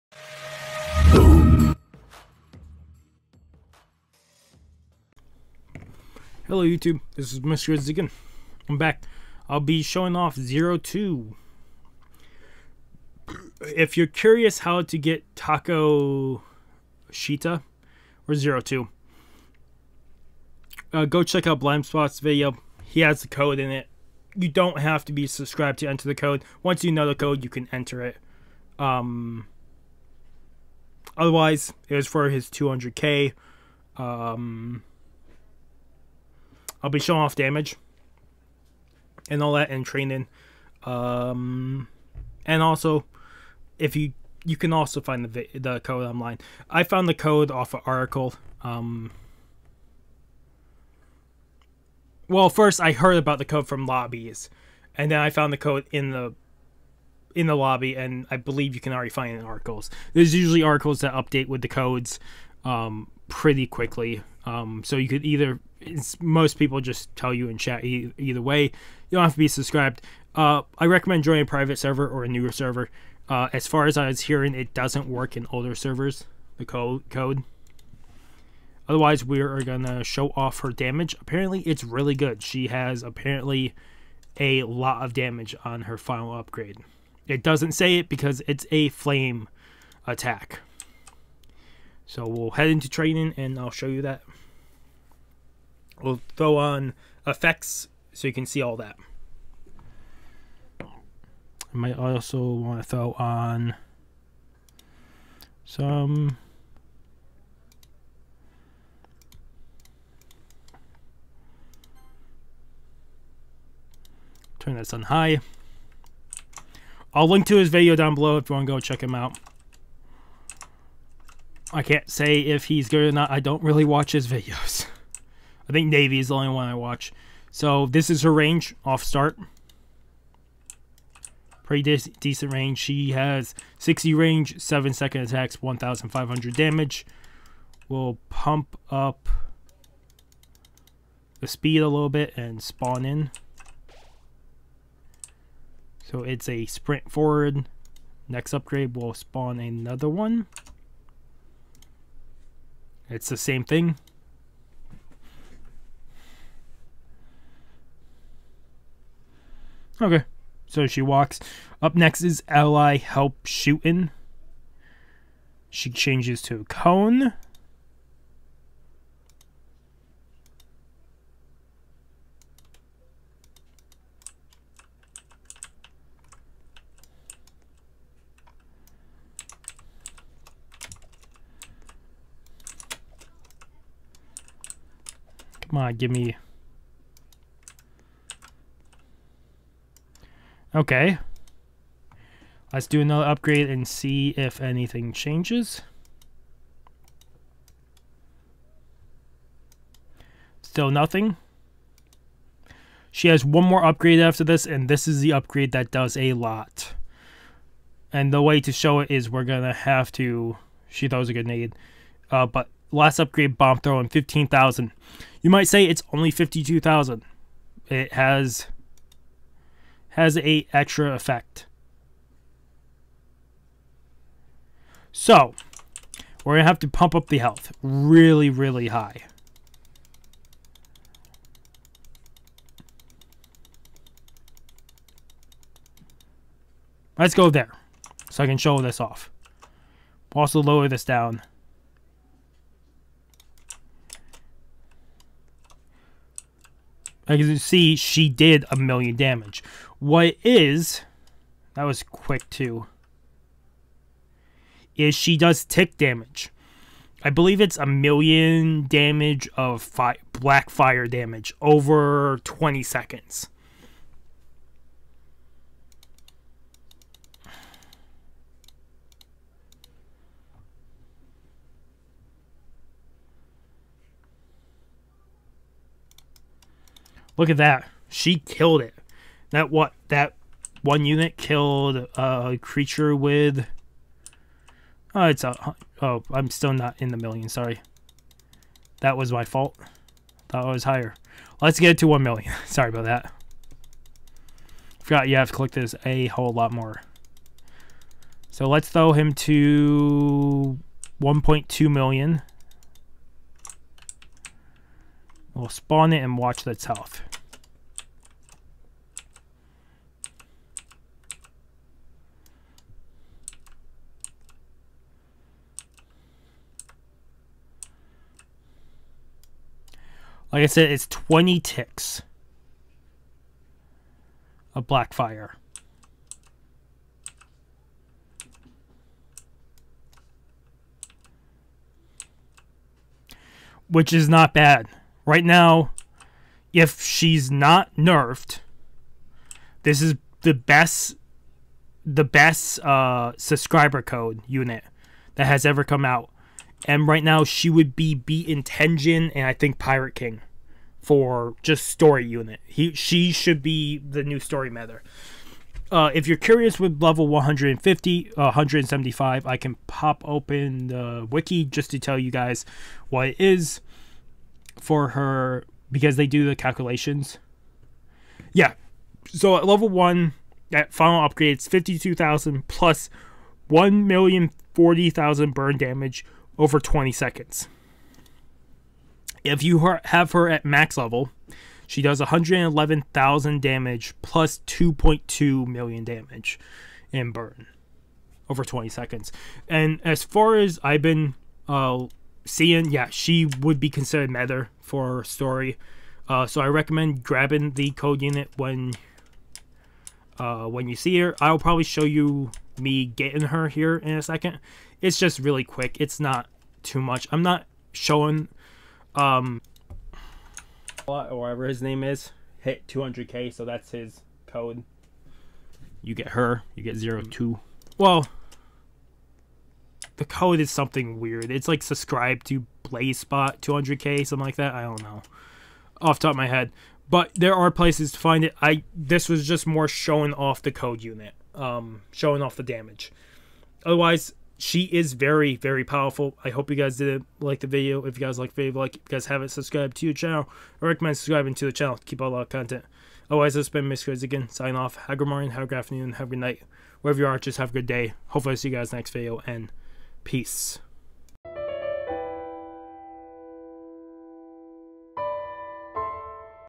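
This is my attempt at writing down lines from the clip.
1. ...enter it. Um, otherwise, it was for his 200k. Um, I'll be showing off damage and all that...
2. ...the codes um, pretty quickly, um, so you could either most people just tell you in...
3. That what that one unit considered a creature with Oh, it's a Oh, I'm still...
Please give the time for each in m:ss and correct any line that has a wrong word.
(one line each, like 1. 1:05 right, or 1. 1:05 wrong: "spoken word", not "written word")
1. 0:27 right
2. 1:01 right
3. 4:39 wrong: "killed", not "considered".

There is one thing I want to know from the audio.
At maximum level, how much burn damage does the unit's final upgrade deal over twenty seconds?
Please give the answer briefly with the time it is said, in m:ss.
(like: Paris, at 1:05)
2.2 million, at 6:24.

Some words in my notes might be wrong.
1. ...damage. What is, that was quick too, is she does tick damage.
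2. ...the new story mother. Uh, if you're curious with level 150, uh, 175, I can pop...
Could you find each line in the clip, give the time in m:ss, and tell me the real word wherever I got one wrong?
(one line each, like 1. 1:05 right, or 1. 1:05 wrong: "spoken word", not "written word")
1. 4:09 right
2. 5:53 right.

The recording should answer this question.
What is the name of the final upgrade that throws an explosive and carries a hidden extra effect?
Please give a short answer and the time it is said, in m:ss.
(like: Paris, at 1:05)
bomb throwing, at 3:33.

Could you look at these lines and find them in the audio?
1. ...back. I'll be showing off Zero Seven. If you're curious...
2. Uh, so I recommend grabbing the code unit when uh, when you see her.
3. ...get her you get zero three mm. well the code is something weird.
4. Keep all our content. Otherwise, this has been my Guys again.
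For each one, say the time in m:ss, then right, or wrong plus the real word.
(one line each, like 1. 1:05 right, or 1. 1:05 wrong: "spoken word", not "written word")
1. 0:08 wrong: "Two", not "Seven"
2. 6:36 right
3. 6:56 wrong: "two", not "three"
4. 7:22 right.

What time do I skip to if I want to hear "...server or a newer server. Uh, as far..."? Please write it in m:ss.
1:11.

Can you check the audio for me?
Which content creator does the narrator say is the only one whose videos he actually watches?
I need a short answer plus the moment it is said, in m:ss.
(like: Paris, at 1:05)
Navy, at 2:05.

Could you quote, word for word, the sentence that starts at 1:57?
I'll link to his video down below if you want to go check him out.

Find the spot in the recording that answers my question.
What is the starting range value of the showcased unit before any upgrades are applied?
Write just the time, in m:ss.
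2:13.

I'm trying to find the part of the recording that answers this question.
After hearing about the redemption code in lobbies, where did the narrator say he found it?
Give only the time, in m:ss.
0:47.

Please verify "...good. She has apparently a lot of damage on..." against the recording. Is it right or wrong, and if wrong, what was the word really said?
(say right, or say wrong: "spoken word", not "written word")
right.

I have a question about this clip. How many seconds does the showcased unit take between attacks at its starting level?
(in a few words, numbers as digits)
7 seconds.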